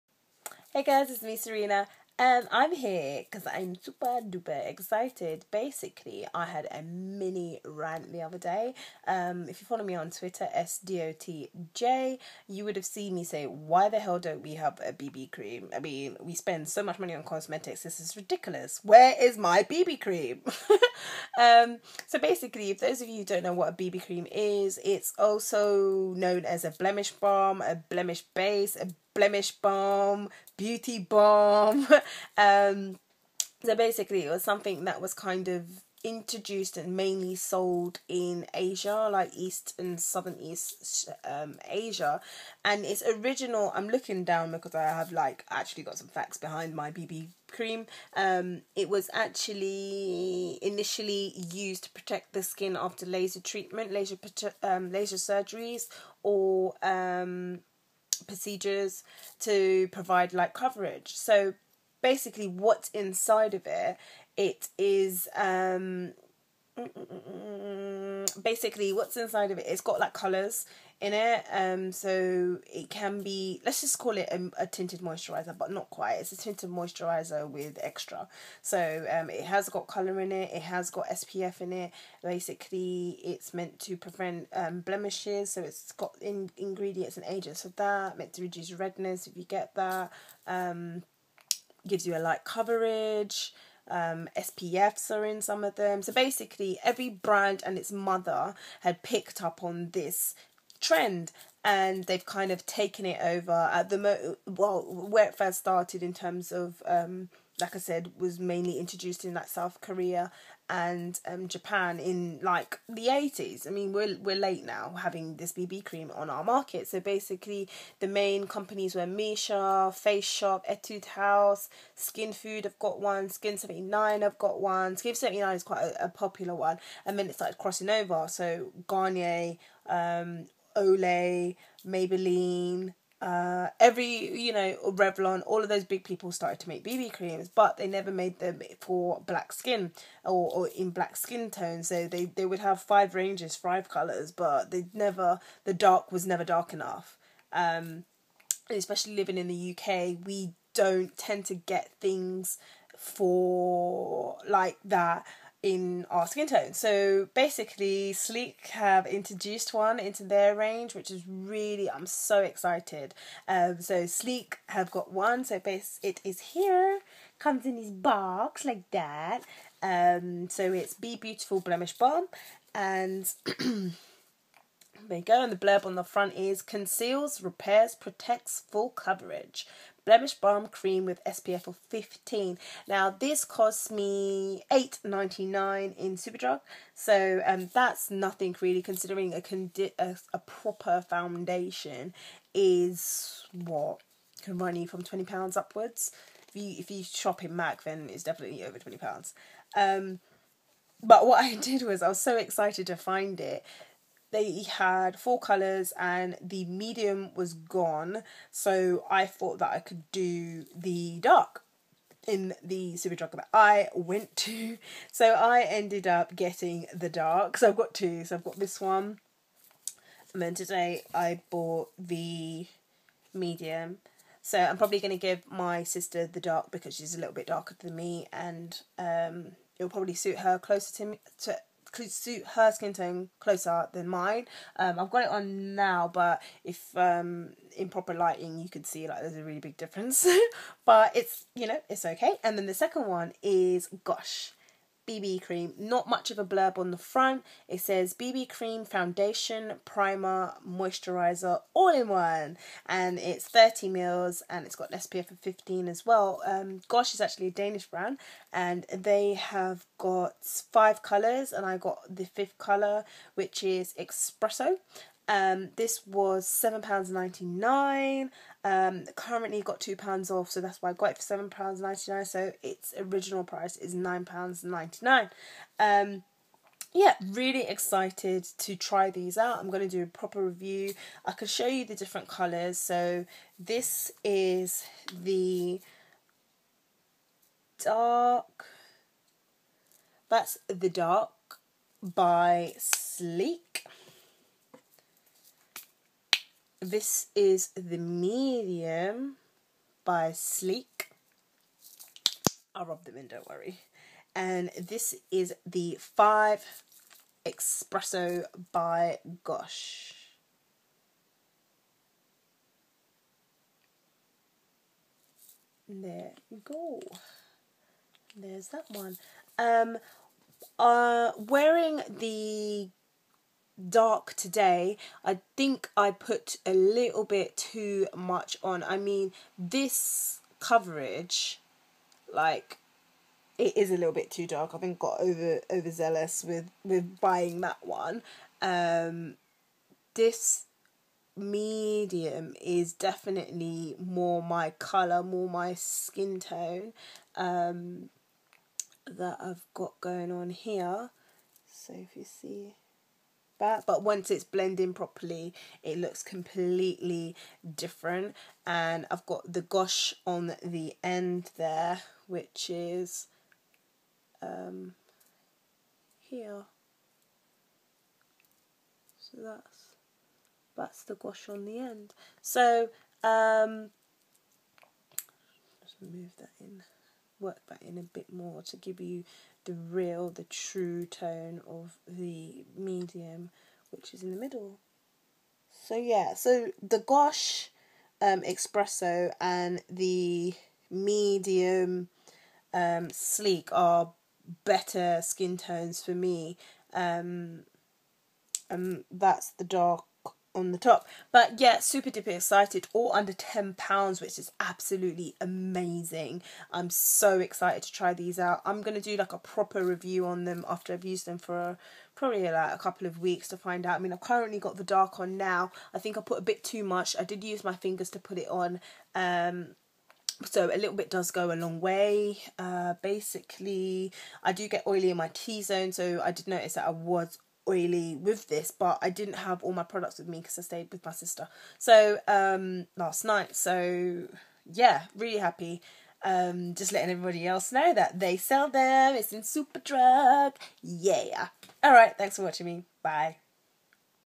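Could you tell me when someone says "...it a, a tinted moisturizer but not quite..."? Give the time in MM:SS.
01:14.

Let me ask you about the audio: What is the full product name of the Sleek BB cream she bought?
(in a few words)
Be Beautiful Blemish Balm.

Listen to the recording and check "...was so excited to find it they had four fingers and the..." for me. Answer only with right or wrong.
wrong.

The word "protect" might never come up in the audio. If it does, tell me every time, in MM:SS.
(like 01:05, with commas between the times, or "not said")
00:51, 02:57.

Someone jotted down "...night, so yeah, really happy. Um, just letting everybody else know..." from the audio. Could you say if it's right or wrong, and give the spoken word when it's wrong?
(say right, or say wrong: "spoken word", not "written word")
right.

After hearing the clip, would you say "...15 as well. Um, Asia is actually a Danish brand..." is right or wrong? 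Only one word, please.
wrong.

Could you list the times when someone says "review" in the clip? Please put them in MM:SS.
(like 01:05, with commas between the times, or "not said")
04:40, 06:49.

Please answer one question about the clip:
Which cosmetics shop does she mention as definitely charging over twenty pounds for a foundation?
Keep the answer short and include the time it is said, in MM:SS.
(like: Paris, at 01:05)
Mac, at 03:17.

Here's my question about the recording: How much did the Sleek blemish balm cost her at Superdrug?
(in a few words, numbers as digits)
£8.99.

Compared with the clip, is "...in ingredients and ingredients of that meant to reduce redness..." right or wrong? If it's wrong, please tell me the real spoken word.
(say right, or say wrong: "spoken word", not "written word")
wrong: "agents", not "ingredients".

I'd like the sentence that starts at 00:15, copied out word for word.
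I mean, we spend so much money on cosmetics, this is ridiculous.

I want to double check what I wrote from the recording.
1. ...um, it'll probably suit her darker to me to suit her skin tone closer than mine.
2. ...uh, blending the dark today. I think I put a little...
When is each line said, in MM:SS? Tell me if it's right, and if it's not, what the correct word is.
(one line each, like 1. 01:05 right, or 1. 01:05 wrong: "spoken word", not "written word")
1. 03:48 wrong: "closer", not "darker"
2. 05:20 wrong: "wearing", not "blending".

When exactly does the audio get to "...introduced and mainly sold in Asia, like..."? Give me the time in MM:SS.
00:36.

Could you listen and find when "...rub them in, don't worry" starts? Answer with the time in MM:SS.
05:02.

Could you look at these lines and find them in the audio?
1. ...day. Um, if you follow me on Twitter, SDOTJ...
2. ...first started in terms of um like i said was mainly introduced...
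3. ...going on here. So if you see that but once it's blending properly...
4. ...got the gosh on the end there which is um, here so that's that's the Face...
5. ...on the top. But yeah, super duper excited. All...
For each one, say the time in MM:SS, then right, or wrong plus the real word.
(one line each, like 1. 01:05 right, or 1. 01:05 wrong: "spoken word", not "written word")
1. 00:08 right
2. 01:45 right
3. 05:50 right
4. 05:59 wrong: "Gosh", not "Face"
5. 06:40 right.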